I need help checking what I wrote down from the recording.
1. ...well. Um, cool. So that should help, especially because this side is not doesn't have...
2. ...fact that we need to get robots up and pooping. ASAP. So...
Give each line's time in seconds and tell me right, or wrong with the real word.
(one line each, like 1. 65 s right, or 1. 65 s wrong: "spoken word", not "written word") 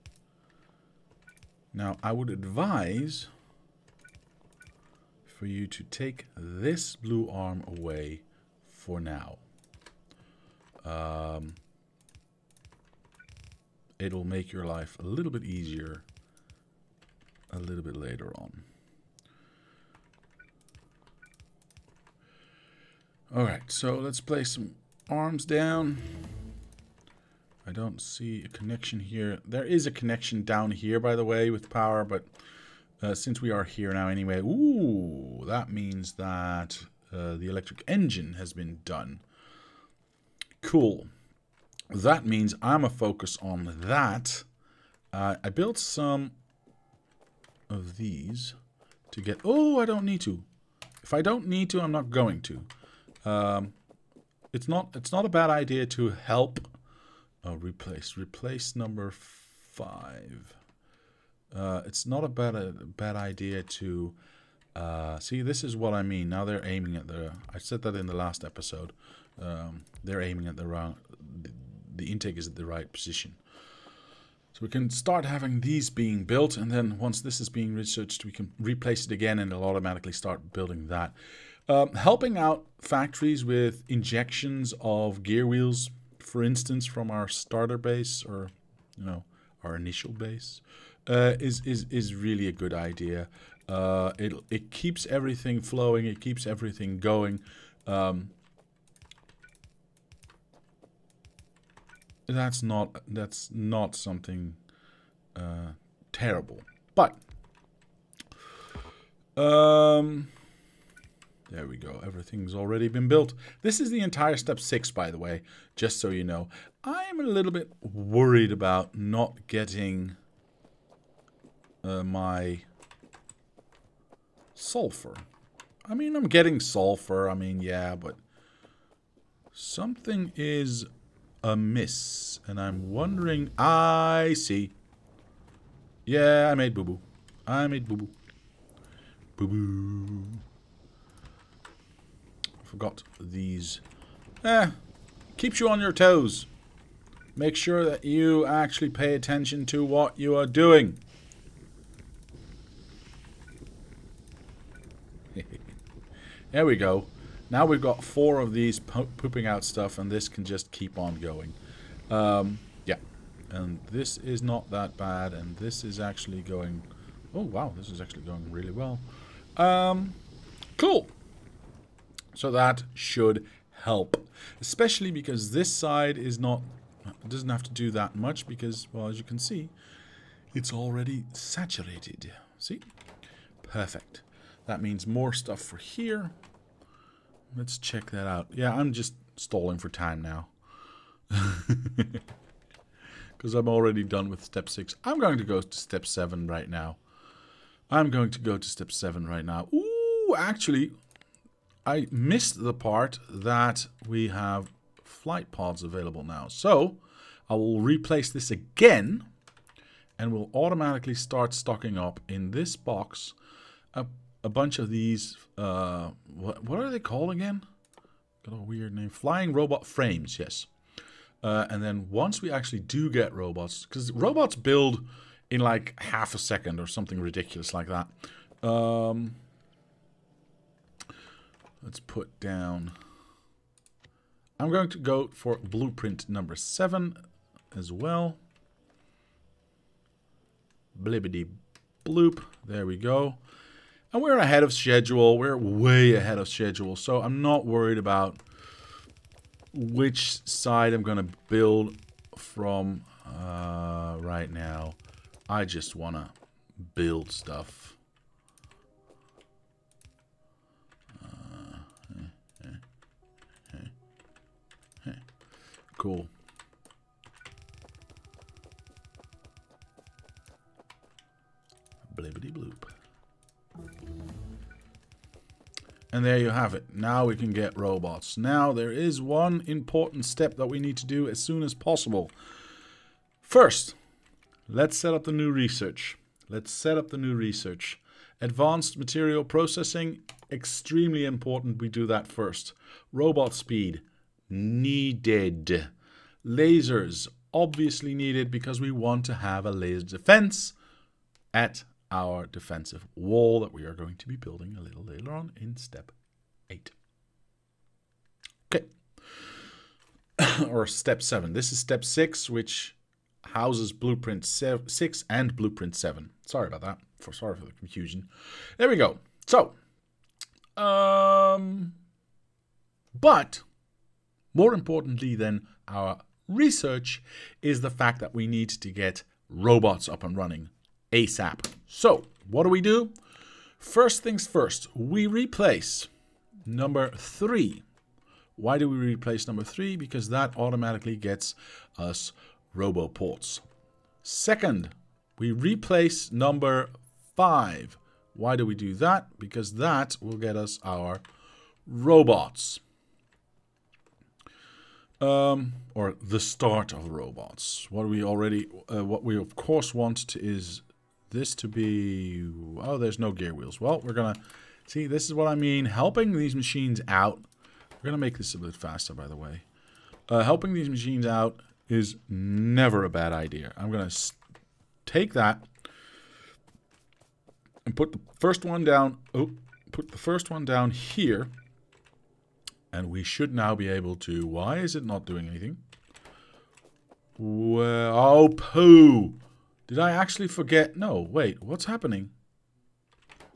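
1. 168 s right
2. 327 s wrong: "running", not "pooping".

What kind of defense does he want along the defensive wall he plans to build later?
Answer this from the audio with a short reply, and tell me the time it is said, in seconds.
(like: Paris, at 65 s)
Laser defense, at 299 s.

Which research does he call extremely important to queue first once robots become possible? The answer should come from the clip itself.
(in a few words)
Advanced material processing.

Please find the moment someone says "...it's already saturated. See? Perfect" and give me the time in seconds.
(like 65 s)
180 s.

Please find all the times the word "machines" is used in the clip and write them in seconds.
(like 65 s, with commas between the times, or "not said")
366 s, 370 s.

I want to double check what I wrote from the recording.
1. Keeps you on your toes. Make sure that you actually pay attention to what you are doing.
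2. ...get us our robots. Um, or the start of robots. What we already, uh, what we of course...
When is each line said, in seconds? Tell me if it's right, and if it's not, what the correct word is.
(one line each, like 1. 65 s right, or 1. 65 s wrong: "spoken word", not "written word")
1. 145 s right
2. 350 s right.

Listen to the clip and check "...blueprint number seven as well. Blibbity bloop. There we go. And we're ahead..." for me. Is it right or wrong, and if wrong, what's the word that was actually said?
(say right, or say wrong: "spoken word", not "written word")
right.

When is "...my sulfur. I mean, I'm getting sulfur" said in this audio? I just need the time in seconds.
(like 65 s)
122 s.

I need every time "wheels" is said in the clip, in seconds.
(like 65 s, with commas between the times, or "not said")
85 s, 363 s.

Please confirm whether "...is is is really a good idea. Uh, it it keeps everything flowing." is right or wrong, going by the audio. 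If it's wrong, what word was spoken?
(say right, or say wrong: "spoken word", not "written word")
right.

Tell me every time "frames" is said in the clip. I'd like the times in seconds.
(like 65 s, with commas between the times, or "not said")
219 s.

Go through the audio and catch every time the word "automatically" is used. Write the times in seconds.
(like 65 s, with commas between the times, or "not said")
79 s, 210 s, 340 s.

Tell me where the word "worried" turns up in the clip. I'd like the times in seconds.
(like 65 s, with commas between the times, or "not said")
117 s, 247 s.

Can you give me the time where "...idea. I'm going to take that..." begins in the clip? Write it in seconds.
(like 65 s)
373 s.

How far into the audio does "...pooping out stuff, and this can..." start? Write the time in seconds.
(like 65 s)
159 s.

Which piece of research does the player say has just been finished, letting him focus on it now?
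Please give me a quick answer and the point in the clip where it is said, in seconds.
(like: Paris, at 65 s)
Electric engine, at 37 s.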